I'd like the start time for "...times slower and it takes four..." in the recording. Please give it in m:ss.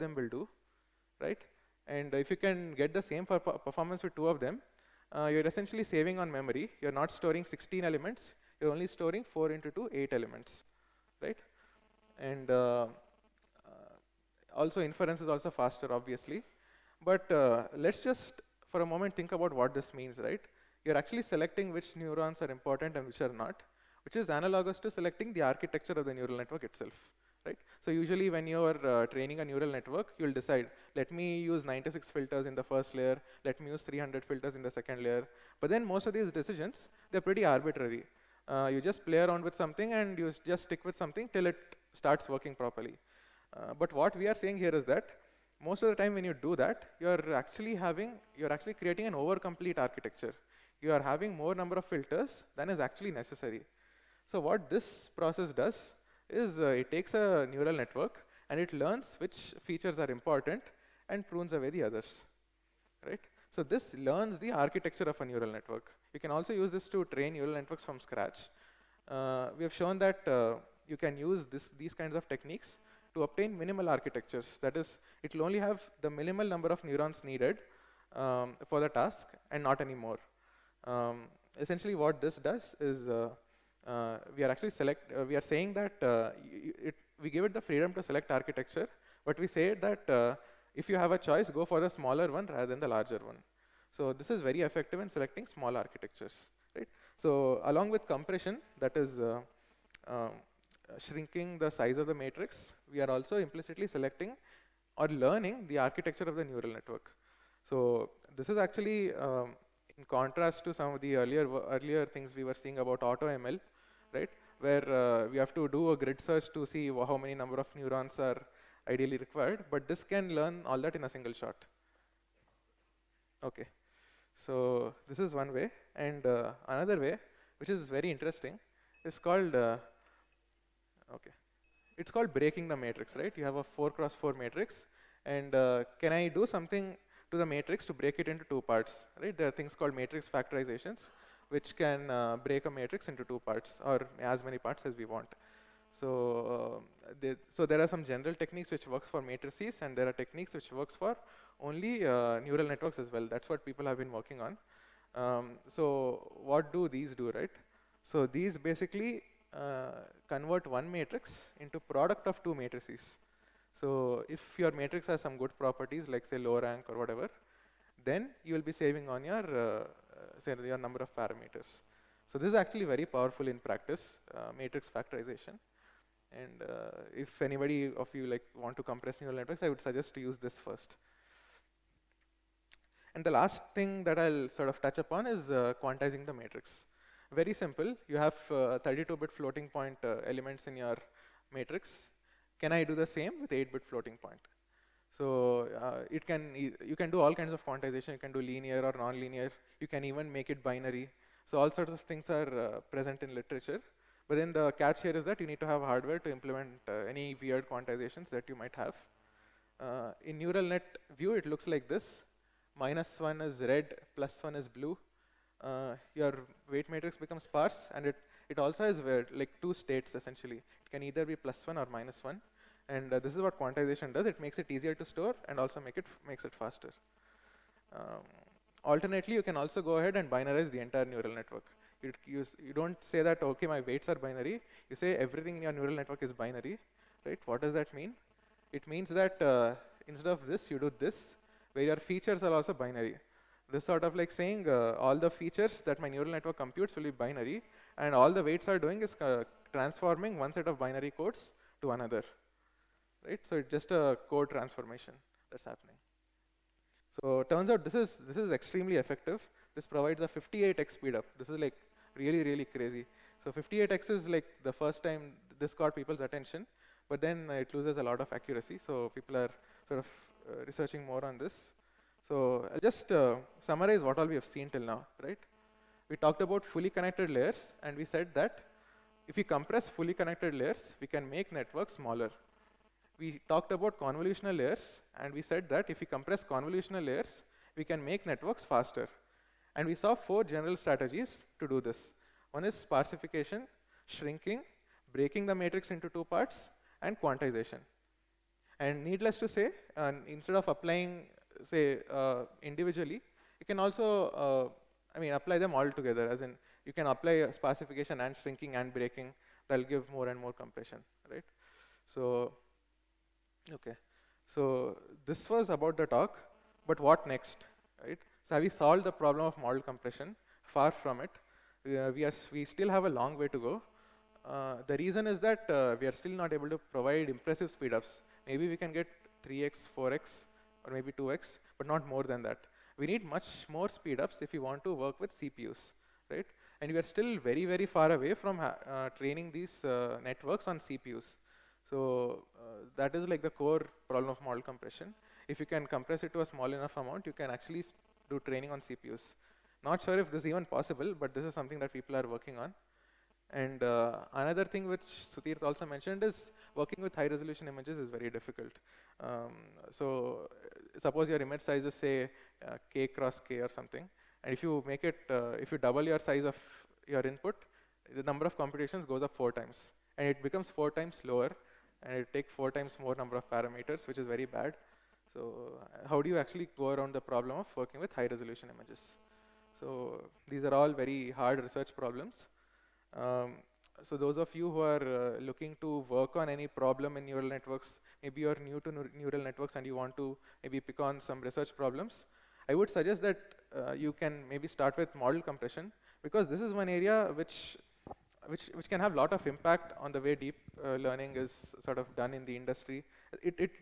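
6:10.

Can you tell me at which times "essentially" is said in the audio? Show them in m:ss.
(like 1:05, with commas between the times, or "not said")
0:05, 1:21, 3:40.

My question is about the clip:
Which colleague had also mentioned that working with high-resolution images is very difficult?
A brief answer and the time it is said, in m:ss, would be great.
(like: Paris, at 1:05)
Sudhir, at 5:55.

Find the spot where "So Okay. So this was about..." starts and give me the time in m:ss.
5:12.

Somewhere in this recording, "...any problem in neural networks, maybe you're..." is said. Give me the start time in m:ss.
6:26.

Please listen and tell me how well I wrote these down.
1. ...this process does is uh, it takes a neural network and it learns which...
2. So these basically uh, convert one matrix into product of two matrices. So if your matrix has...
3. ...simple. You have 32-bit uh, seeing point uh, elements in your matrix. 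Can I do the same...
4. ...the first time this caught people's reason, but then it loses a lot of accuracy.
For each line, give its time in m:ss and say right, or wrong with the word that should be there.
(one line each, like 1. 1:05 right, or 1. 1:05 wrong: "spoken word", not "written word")
1. 0:54 right
2. 2:38 right
3. 3:07 wrong: "floating", not "seeing"
4. 4:24 wrong: "attention", not "reason".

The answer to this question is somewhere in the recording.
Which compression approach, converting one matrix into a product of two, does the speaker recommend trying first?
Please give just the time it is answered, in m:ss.
2:54.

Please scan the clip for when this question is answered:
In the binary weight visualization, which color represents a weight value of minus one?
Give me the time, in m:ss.
3:33.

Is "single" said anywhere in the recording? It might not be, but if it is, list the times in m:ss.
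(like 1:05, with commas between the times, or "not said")
2:01.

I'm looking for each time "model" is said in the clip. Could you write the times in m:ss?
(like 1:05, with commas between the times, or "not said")
5:19, 5:44, 6:35.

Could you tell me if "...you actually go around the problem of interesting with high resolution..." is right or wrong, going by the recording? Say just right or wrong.
wrong.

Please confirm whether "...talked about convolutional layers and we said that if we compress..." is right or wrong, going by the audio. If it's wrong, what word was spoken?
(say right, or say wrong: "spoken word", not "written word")
right.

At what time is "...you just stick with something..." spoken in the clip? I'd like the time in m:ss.
0:40.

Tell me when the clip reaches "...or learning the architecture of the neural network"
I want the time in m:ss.
1:44.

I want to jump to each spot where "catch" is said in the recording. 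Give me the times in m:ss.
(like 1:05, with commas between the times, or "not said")
3:24.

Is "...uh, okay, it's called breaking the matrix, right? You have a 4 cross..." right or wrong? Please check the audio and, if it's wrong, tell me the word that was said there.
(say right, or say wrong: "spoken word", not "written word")
right.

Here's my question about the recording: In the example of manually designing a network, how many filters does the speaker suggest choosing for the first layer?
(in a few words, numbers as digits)
96.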